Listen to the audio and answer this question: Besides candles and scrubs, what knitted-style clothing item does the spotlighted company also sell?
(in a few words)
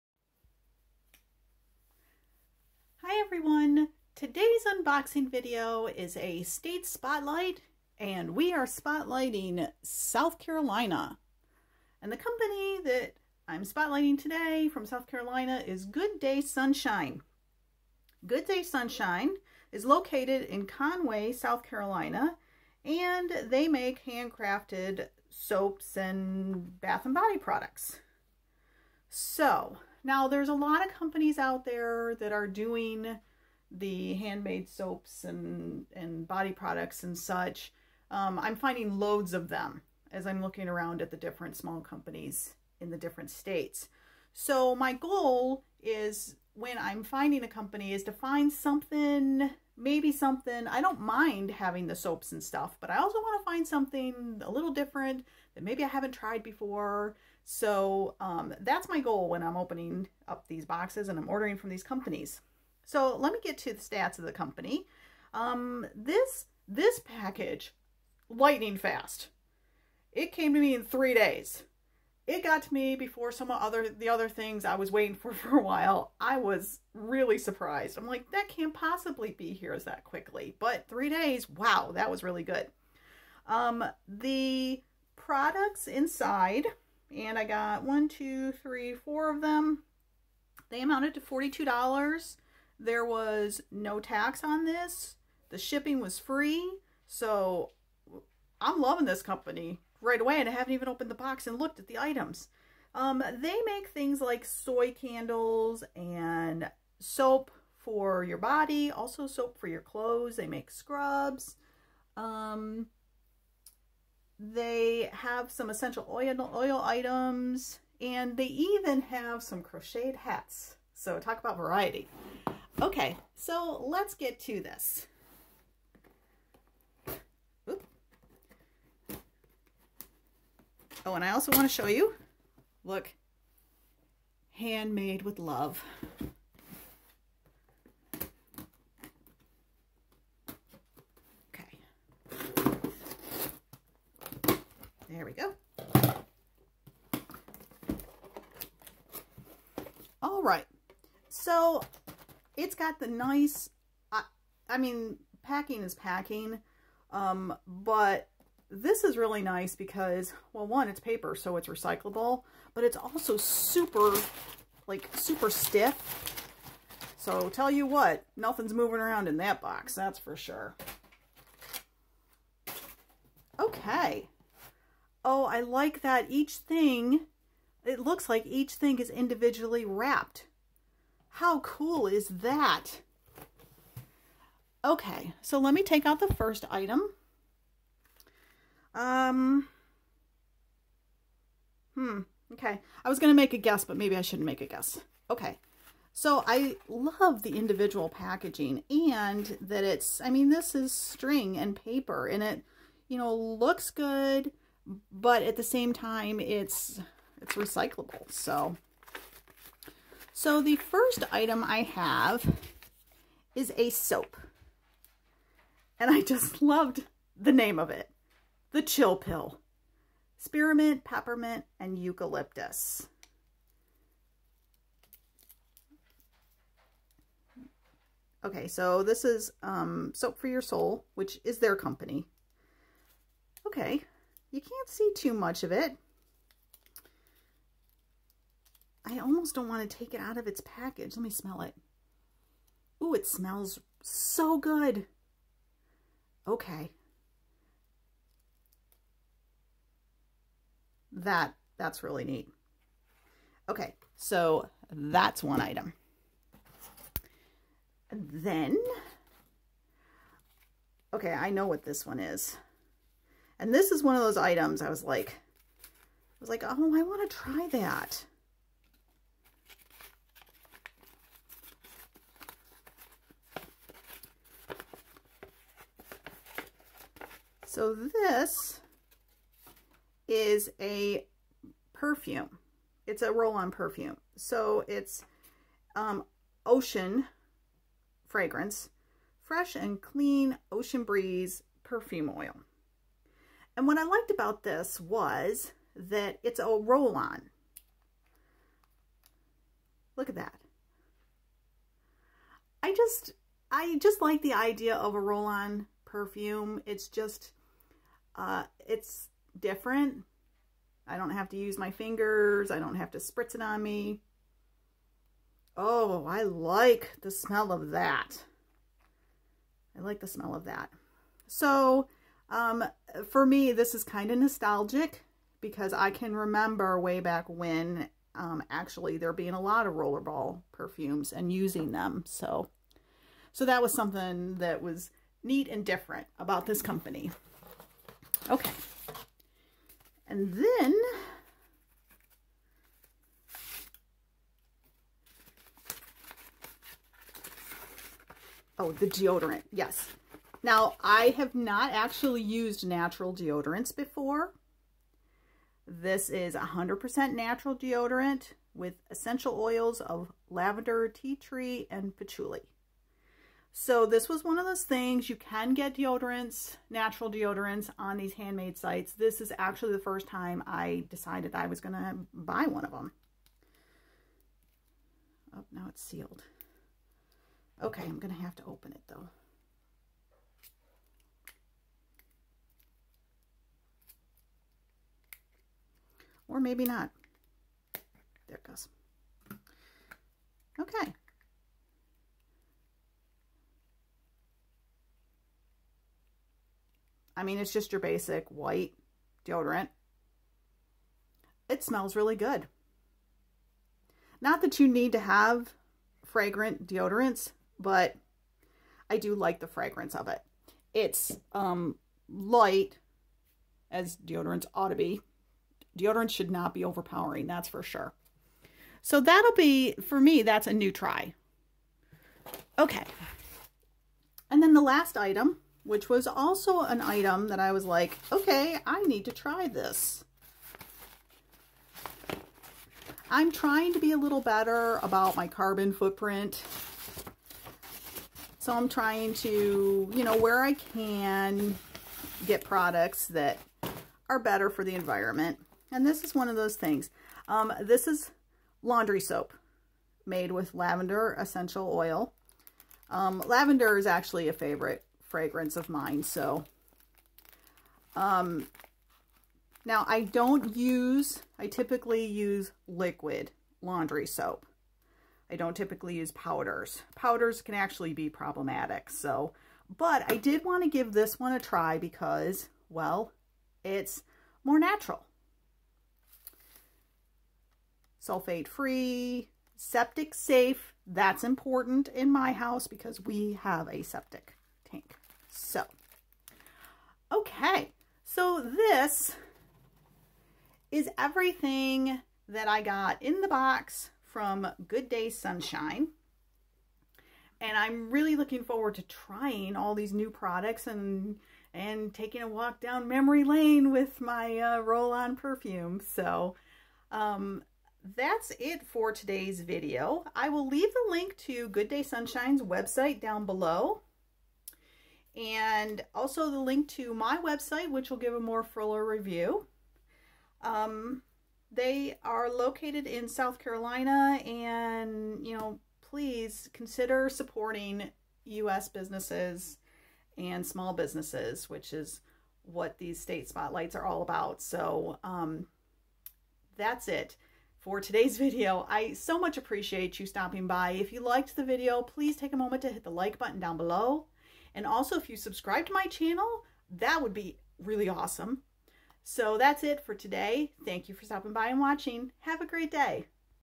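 Crocheted hats.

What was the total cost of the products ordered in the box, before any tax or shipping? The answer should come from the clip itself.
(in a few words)
$42.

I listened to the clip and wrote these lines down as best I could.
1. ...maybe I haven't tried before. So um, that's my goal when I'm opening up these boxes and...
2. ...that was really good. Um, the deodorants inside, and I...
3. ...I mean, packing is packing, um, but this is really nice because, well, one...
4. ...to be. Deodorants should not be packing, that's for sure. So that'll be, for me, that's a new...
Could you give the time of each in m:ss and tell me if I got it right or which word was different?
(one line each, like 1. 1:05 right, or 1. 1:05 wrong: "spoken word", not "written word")
1. 0:55 right
2. 1:21 wrong: "products", not "deodorants"
3. 2:34 right
4. 6:54 wrong: "overpowering", not "packing".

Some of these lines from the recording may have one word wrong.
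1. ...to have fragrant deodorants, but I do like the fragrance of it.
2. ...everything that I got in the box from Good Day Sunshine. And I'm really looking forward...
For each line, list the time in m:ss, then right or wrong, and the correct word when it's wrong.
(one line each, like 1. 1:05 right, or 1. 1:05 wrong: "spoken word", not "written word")
1. 6:45 right
2. 8:11 right.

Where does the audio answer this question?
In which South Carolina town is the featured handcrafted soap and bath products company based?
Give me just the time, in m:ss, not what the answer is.
0:20.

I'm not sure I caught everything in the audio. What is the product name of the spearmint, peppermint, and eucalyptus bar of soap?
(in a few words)
The Chill Pill.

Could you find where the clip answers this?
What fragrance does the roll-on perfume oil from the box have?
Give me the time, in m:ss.
4:50.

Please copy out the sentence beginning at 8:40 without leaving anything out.
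Um, they are located in South Carolina, and you know, please consider supporting U.S.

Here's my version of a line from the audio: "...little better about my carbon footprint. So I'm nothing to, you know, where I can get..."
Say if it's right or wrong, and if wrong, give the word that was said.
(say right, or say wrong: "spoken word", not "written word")
wrong: "trying", not "nothing".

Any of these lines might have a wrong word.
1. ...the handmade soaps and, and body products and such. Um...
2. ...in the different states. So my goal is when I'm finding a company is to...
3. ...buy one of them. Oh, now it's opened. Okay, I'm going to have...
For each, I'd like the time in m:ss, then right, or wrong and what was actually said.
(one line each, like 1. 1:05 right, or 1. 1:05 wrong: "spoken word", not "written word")
1. 0:33 right
2. 0:42 right
3. 6:12 wrong: "sealed", not "opened".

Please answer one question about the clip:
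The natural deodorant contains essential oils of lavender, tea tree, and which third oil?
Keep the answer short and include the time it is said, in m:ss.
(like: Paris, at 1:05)
Patchouli, at 6:02.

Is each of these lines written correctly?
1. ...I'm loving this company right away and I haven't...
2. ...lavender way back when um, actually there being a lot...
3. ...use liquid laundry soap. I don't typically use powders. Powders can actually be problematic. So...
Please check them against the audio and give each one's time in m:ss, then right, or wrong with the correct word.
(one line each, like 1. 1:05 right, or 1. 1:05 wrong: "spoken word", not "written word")
1. 1:38 right
2. 5:26 wrong: "remember", not "lavender"
3. 7:42 right.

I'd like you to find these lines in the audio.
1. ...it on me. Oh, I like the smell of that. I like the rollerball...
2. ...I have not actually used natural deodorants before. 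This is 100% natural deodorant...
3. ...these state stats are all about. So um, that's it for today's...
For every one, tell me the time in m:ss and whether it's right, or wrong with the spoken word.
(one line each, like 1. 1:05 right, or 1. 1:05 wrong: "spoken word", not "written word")
1. 5:13 wrong: "smell", not "rollerball"
2. 5:51 right
3. 8:52 wrong: "spotlights", not "stats".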